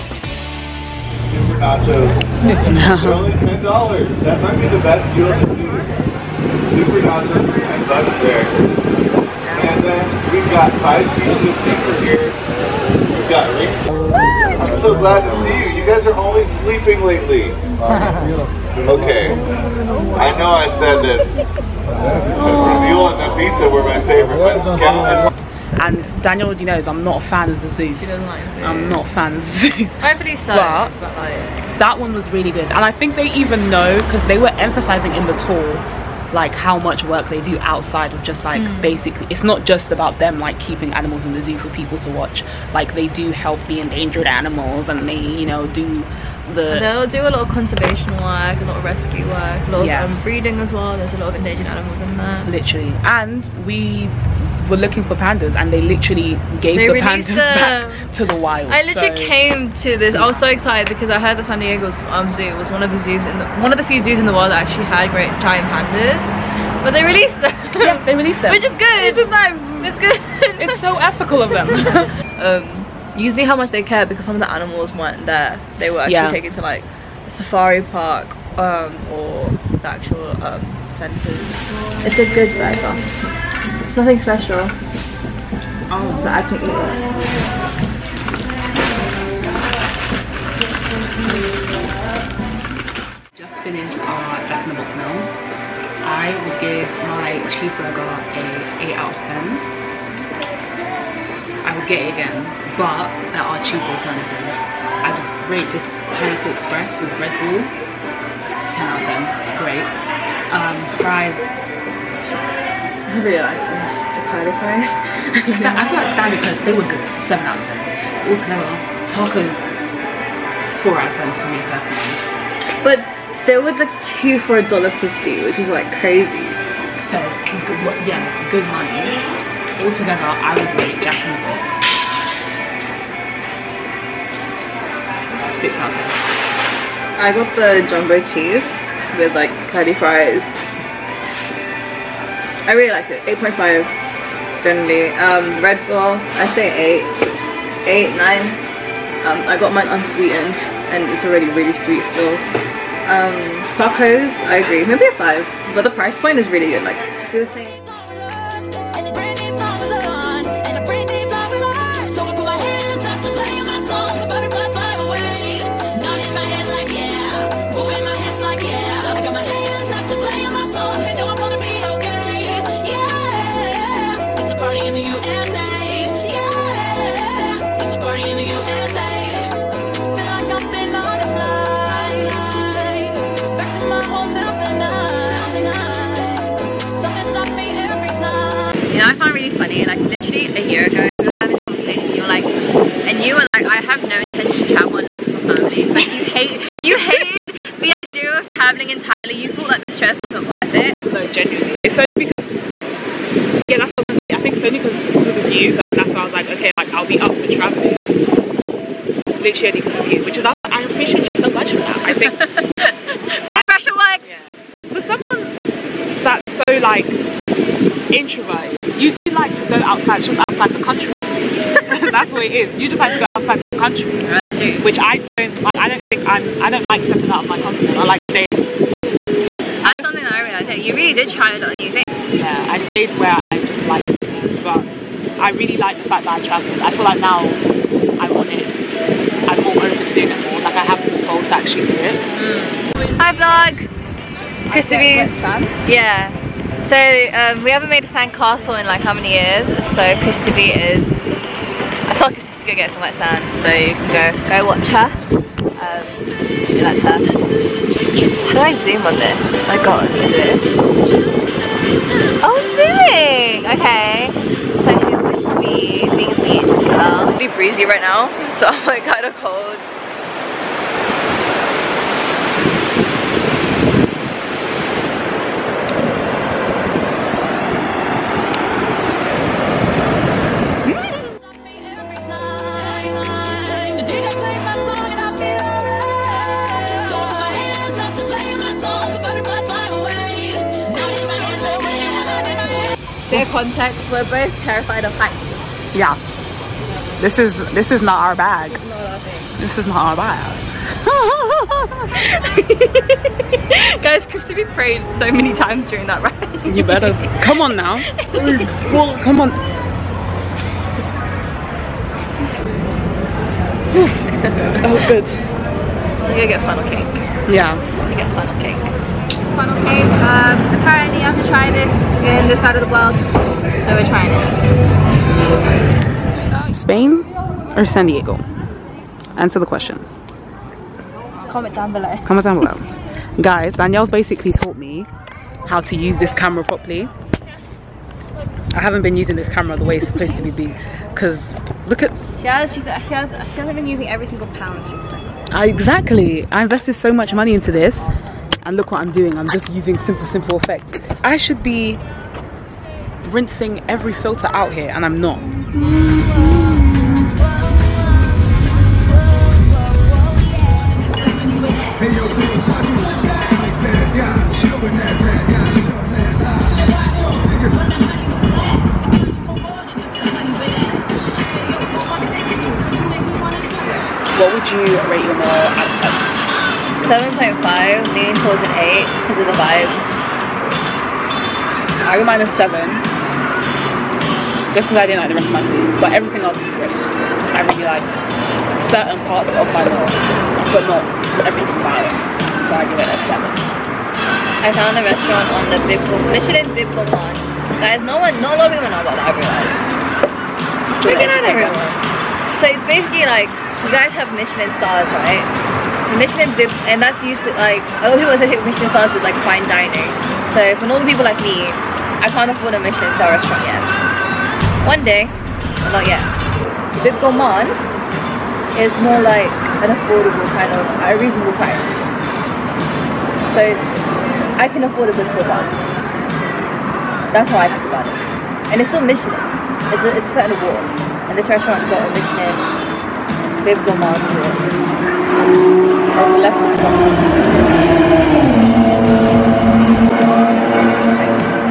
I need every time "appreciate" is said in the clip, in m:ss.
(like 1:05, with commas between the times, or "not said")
3:30.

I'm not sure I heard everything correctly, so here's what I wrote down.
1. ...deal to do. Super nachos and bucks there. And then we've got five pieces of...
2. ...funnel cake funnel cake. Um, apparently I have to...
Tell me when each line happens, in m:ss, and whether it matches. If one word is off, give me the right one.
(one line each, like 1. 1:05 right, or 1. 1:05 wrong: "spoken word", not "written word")
1. 0:05 right
2. 5:18 right.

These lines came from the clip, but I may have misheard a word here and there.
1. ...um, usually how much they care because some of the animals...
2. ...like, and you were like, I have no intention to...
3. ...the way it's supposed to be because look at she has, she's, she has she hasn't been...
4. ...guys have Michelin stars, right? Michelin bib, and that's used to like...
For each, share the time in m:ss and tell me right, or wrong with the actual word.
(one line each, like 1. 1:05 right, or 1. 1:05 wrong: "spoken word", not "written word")
1. 1:12 right
2. 3:12 right
3. 5:39 right
4. 6:43 right.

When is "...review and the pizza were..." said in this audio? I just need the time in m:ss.
0:21.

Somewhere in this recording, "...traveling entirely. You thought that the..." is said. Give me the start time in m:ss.
3:18.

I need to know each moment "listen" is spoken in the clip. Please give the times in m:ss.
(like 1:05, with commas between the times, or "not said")
not said.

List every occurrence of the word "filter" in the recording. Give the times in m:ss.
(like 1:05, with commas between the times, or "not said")
5:54.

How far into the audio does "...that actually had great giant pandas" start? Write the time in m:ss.
1:04.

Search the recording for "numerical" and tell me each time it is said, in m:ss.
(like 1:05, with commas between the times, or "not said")
not said.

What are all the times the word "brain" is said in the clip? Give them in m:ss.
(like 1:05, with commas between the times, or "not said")
not said.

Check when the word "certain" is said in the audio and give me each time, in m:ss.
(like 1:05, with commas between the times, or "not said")
6:28, 7:10.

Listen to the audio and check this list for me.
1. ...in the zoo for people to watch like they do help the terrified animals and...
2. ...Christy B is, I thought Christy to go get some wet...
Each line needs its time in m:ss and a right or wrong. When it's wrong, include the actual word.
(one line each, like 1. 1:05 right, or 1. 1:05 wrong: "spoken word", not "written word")
1. 0:41 wrong: "endangered", not "terrified"
2. 4:10 right.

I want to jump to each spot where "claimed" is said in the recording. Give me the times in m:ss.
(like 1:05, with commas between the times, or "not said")
not said.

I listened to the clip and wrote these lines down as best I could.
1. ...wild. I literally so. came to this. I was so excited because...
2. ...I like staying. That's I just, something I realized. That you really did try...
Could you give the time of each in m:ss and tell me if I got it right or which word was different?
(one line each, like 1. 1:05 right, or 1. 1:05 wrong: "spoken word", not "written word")
1. 0:58 right
2. 3:47 right.